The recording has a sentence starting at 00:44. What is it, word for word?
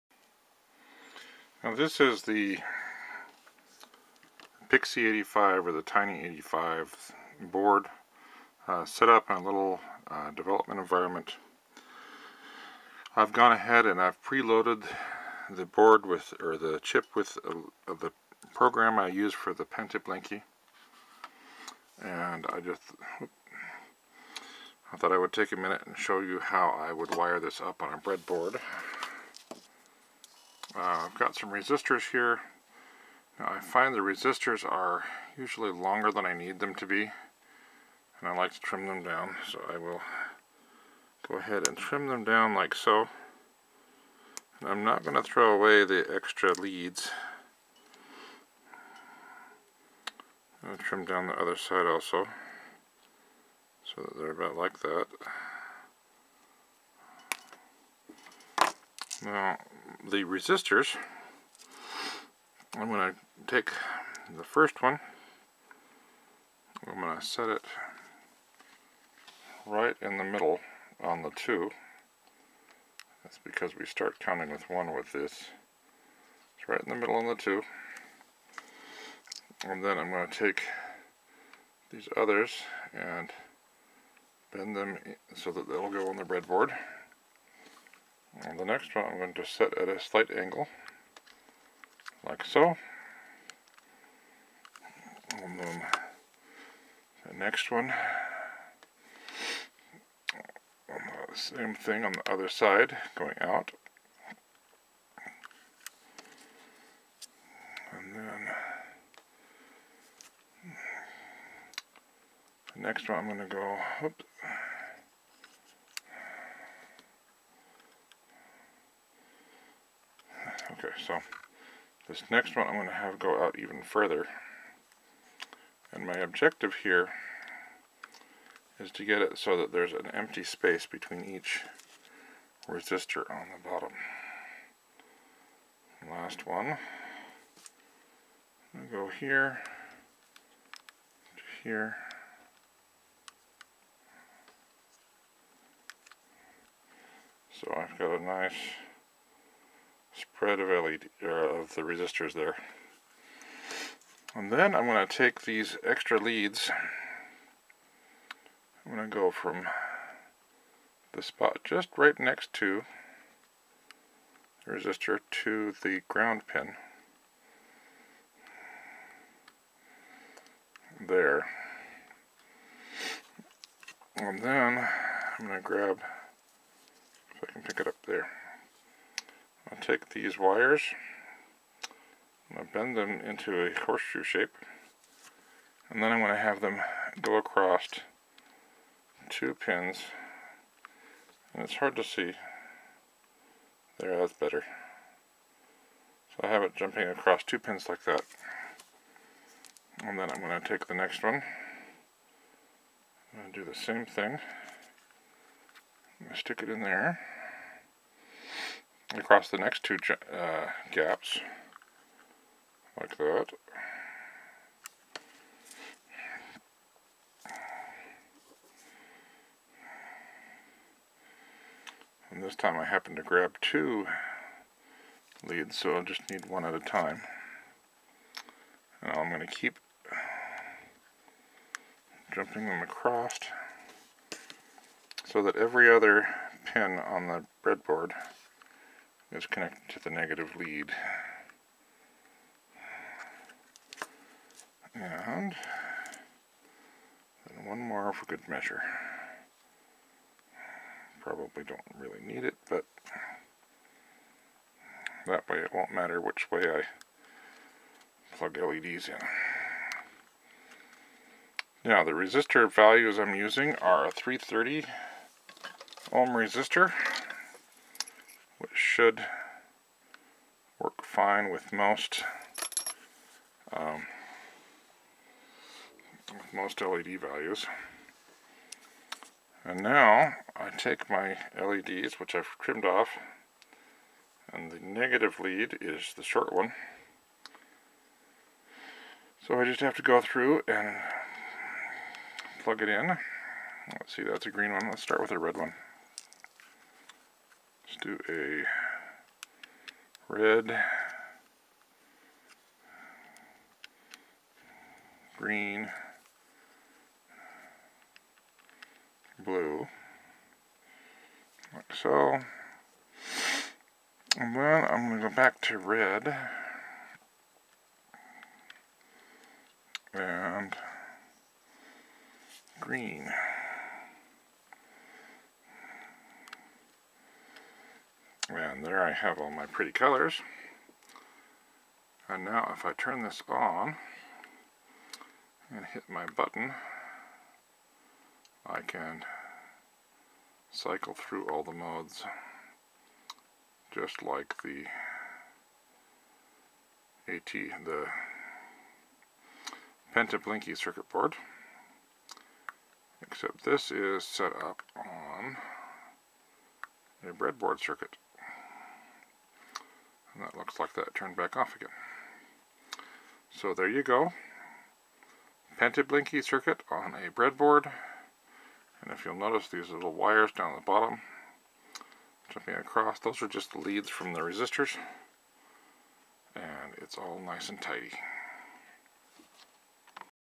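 And I'm not going to throw away the extra leads.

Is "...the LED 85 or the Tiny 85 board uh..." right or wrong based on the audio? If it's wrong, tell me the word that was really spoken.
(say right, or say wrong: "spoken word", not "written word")
wrong: "Pixie", not "LED".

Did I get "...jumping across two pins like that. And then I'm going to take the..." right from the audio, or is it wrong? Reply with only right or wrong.
right.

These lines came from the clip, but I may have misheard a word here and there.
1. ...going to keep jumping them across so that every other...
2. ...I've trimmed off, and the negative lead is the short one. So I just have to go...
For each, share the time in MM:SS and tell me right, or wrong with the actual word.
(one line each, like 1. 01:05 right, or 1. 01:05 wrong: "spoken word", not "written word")
1. 03:49 right
2. 04:42 right.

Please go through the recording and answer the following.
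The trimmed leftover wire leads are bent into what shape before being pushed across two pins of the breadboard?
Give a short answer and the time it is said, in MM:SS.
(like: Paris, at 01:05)
Horseshoe, at 03:03.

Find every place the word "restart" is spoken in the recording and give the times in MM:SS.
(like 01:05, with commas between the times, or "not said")
not said.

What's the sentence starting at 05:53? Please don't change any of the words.
Except this is set up on a breadboard circuit that looks like that turned back off again.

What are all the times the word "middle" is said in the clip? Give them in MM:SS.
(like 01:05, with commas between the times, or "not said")
01:10, 01:16.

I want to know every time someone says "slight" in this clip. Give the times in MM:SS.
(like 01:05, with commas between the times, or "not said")
01:29.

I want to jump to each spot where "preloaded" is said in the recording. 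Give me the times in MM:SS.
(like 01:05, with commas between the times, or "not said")
00:14.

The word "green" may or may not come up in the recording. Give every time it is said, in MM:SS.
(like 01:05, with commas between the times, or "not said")
04:54, 05:05, 05:22.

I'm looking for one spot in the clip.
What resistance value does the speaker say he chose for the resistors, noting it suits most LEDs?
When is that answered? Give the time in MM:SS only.
04:24.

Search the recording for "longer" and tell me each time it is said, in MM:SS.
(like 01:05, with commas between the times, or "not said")
00:35.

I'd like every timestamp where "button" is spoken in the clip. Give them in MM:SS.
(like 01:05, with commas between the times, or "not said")
05:36.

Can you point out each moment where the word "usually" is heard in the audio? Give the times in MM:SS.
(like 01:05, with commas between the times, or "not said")
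00:35.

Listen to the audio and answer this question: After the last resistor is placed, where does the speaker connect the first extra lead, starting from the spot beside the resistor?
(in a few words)
Ground pin.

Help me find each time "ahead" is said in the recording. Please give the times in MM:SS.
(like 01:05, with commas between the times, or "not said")
00:13, 00:41.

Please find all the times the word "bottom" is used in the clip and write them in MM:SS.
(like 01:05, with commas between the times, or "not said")
02:13, 06:10.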